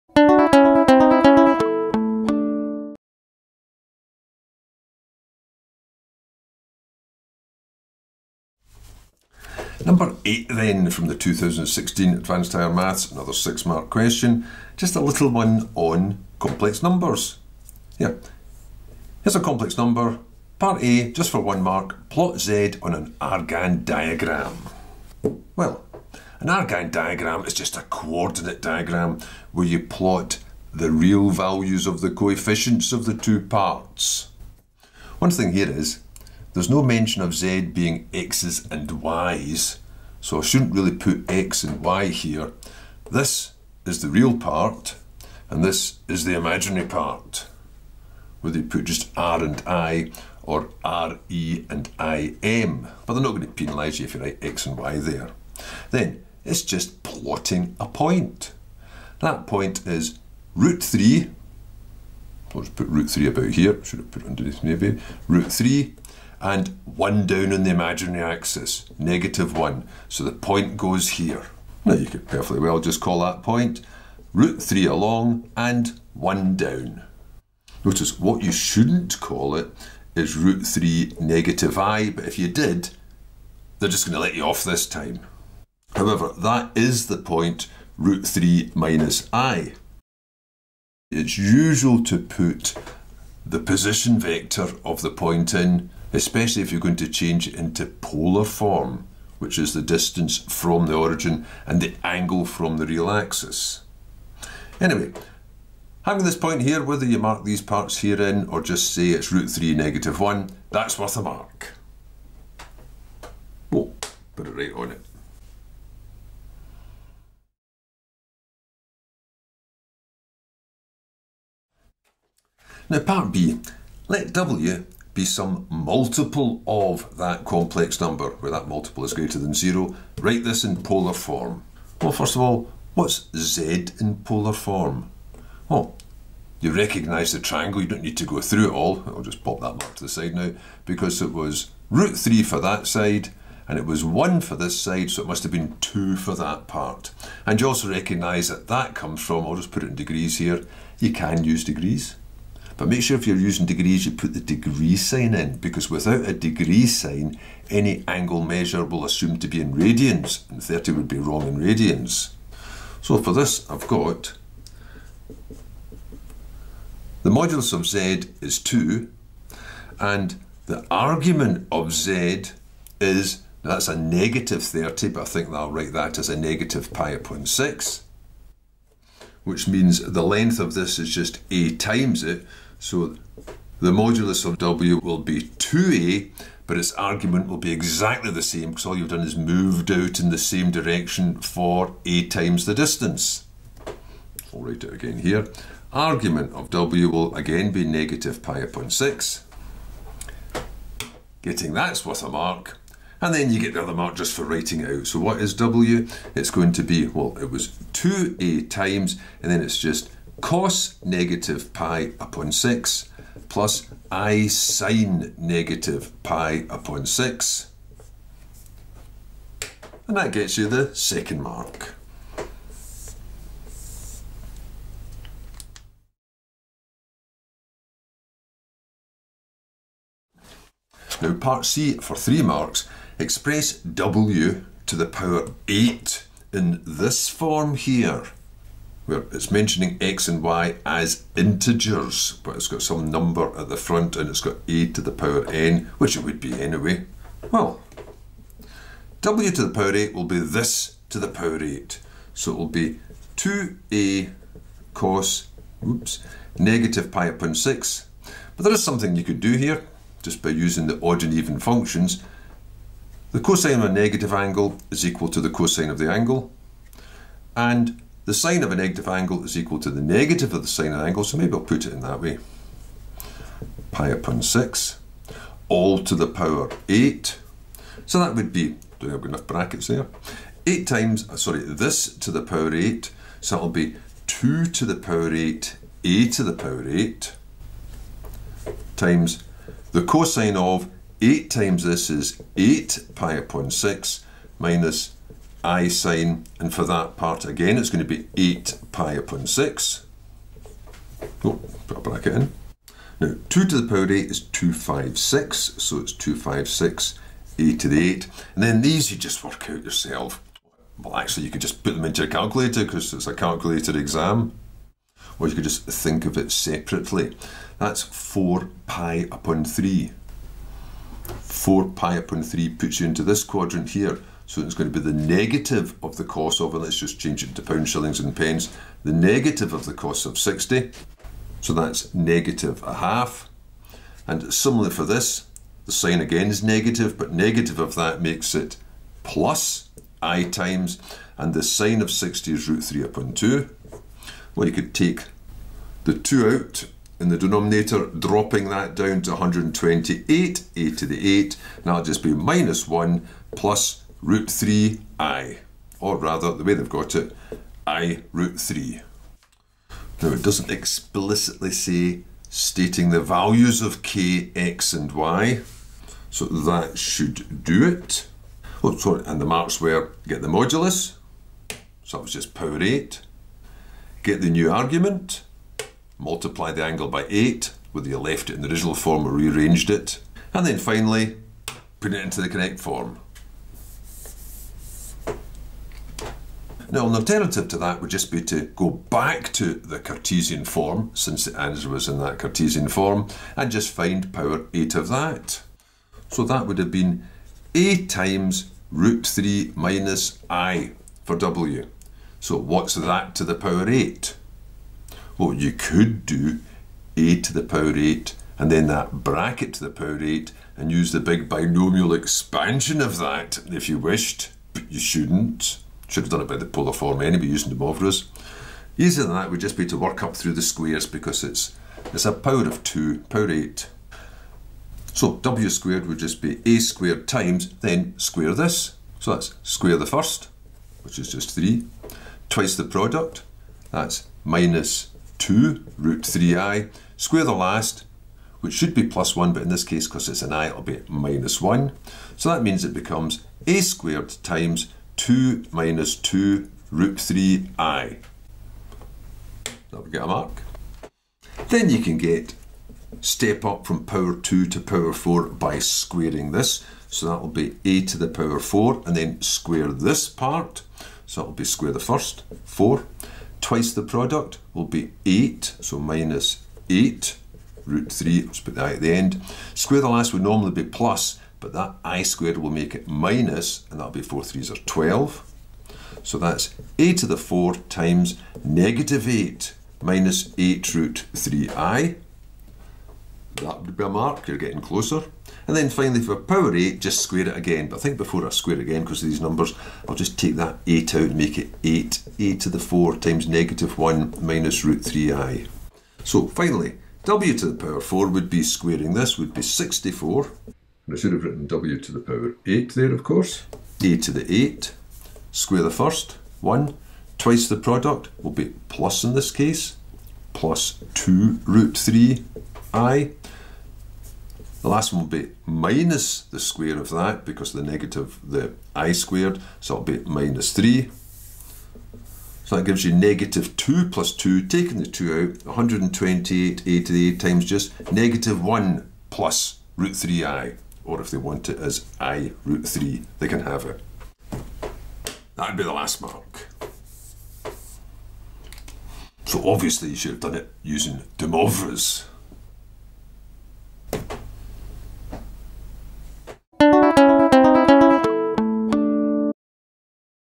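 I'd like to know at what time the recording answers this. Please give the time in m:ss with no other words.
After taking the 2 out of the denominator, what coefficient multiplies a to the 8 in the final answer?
5:49.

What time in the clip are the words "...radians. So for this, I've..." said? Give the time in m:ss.
2:41.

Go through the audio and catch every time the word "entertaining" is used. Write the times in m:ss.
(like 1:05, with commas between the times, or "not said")
not said.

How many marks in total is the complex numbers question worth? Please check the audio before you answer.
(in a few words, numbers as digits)
6.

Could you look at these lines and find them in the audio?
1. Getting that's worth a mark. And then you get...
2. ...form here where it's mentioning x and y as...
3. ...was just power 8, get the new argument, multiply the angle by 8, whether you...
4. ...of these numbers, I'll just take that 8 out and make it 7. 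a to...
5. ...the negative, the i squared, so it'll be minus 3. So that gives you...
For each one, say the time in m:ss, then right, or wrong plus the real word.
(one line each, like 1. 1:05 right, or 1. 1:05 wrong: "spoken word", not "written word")
1. 3:21 right
2. 3:57 right
3. 6:12 right
4. 8:09 wrong: "8", not "7"
5. 8:37 right.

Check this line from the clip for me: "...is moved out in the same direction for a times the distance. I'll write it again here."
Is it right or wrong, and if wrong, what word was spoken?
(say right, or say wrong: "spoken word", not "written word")
right.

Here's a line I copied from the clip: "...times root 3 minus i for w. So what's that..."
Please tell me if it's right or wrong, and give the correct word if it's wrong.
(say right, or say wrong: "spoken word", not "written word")
right.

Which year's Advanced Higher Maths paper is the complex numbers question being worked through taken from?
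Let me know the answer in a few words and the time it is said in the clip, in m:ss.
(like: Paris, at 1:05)
2016, at 0:11.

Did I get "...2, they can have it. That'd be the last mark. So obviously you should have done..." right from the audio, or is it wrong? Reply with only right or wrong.
wrong.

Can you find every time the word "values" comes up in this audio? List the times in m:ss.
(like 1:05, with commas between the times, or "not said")
0:31, 6:03.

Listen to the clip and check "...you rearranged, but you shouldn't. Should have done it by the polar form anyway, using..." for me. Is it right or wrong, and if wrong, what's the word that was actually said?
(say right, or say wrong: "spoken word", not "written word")
wrong: "wished", not "rearranged".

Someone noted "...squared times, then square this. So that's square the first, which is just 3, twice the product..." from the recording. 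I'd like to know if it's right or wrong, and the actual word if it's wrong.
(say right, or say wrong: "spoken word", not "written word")
right.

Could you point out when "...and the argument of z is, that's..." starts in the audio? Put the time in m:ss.
2:49.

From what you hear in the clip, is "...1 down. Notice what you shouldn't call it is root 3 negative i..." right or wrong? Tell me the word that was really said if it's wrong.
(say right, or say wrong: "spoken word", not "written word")
right.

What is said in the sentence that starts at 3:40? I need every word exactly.
And that gets you the second mark.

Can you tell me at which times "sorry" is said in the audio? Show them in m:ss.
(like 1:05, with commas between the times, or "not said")
4:41, 6:08.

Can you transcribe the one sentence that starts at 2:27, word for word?
And you also recognise that that comes from, I'll just put it in degrees here, you can use degrees.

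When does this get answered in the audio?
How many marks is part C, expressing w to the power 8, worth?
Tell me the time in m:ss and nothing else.
3:52.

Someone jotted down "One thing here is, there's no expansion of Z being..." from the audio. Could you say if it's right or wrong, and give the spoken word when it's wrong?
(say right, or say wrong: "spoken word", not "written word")
wrong: "mention", not "expansion".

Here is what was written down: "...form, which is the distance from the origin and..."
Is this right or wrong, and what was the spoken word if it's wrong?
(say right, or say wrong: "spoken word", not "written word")
right.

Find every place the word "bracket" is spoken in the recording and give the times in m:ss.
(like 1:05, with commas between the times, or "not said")
4:39, 5:02, 6:49.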